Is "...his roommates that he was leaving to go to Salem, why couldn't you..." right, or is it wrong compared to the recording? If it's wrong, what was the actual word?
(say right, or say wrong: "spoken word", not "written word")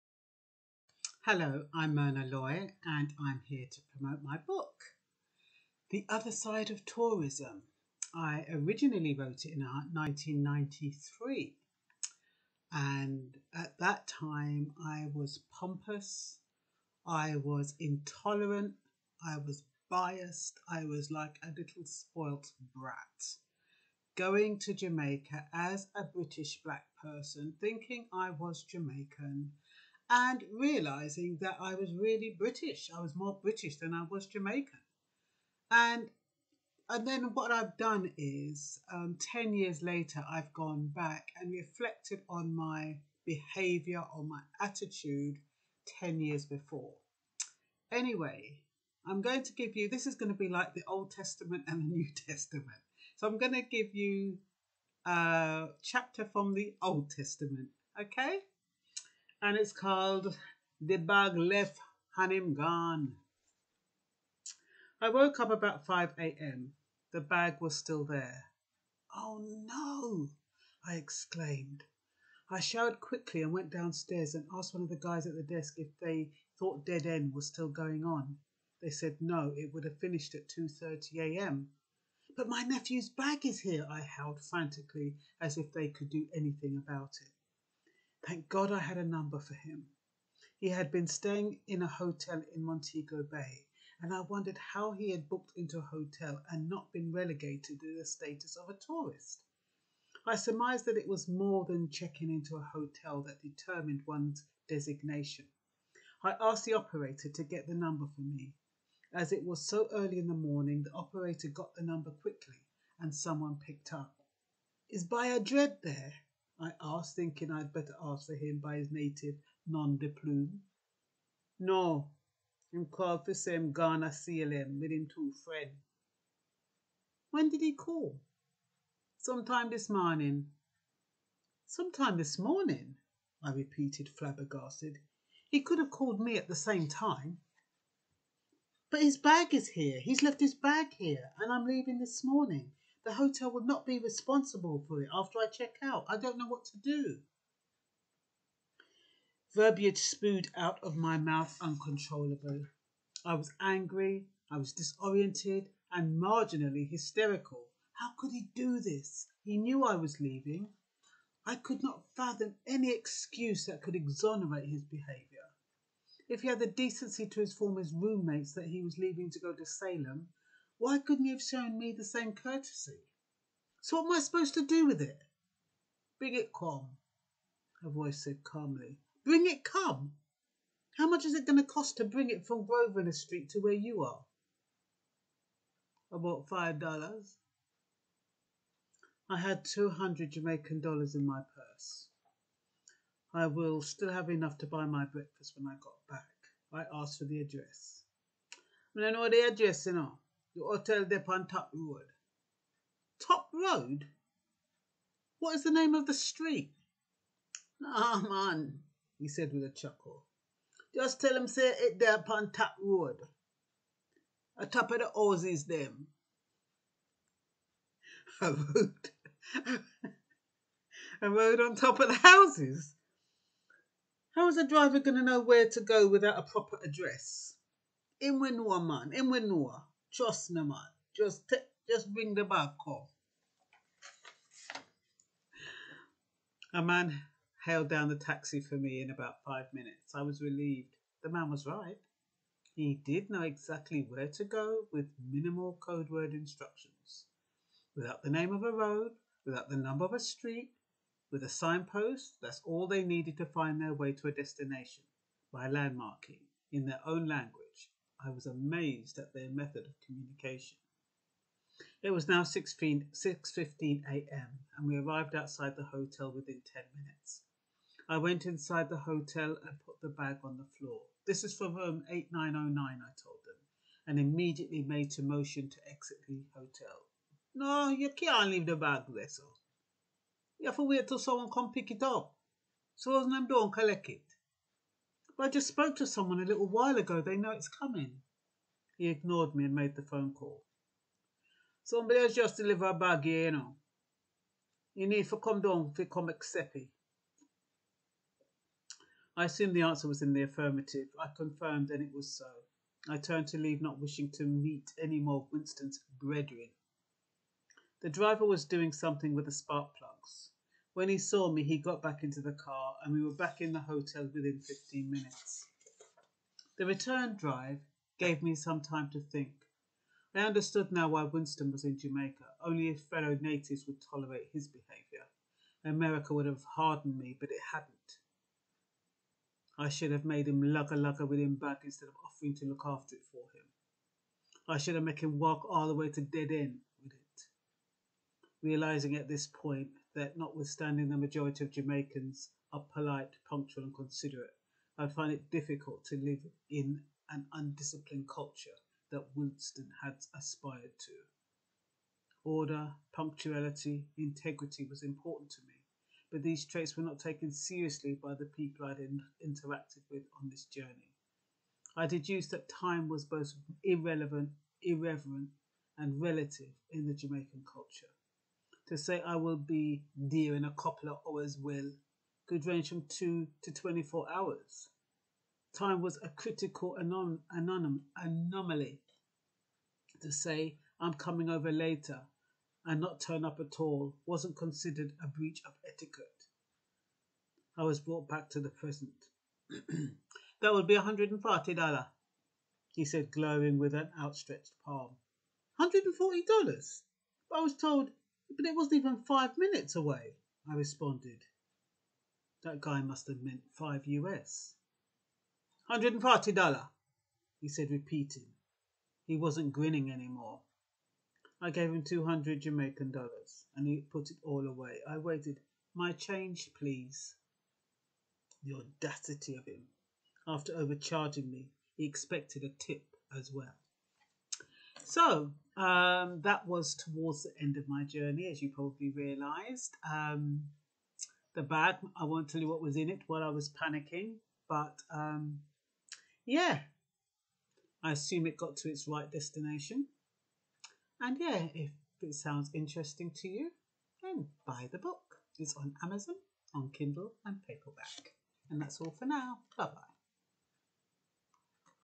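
right.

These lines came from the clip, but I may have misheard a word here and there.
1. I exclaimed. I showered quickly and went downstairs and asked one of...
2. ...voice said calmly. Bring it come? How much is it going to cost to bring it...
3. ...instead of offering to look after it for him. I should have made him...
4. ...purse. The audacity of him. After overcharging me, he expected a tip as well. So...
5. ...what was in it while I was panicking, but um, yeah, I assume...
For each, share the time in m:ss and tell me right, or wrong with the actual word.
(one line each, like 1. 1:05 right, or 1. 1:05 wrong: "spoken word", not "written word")
1. 1:10 right
2. 2:57 right
3. 5:31 right
4. 6:56 wrong: "please", not "purse"
5. 7:12 right.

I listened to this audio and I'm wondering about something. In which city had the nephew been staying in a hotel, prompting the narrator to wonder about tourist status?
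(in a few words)
Montego Bay.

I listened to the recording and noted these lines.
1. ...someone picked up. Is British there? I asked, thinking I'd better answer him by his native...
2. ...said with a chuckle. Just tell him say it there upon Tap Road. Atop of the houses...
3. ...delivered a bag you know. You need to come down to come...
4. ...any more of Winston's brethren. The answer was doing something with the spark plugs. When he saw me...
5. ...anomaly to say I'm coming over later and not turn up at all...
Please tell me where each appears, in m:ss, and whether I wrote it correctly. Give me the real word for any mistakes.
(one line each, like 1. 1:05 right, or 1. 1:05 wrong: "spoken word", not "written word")
1. 1:53 wrong: "Bayadred", not "British"
2. 3:29 right
3. 4:52 right
4. 5:04 wrong: "driver", not "answer"
5. 6:18 right.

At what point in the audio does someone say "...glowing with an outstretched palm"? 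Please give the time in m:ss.
6:33.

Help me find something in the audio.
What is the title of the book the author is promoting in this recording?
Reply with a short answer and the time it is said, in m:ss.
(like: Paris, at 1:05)
The Other Side of Tourism, at 0:05.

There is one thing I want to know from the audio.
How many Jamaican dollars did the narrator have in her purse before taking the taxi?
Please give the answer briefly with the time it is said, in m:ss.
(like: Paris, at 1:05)
200, at 3:09.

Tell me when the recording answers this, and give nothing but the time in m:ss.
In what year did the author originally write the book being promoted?
0:09.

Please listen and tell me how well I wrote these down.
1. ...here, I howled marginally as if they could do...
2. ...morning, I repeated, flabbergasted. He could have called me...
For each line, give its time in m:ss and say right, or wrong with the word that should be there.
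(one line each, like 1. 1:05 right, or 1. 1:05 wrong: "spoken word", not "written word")
1. 1:23 wrong: "frantically", not "marginally"
2. 2:12 right.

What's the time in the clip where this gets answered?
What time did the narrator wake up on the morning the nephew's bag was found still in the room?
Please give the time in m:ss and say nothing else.
1:05.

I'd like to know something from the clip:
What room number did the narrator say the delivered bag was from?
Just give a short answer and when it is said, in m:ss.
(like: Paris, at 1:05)
8909, at 4:32.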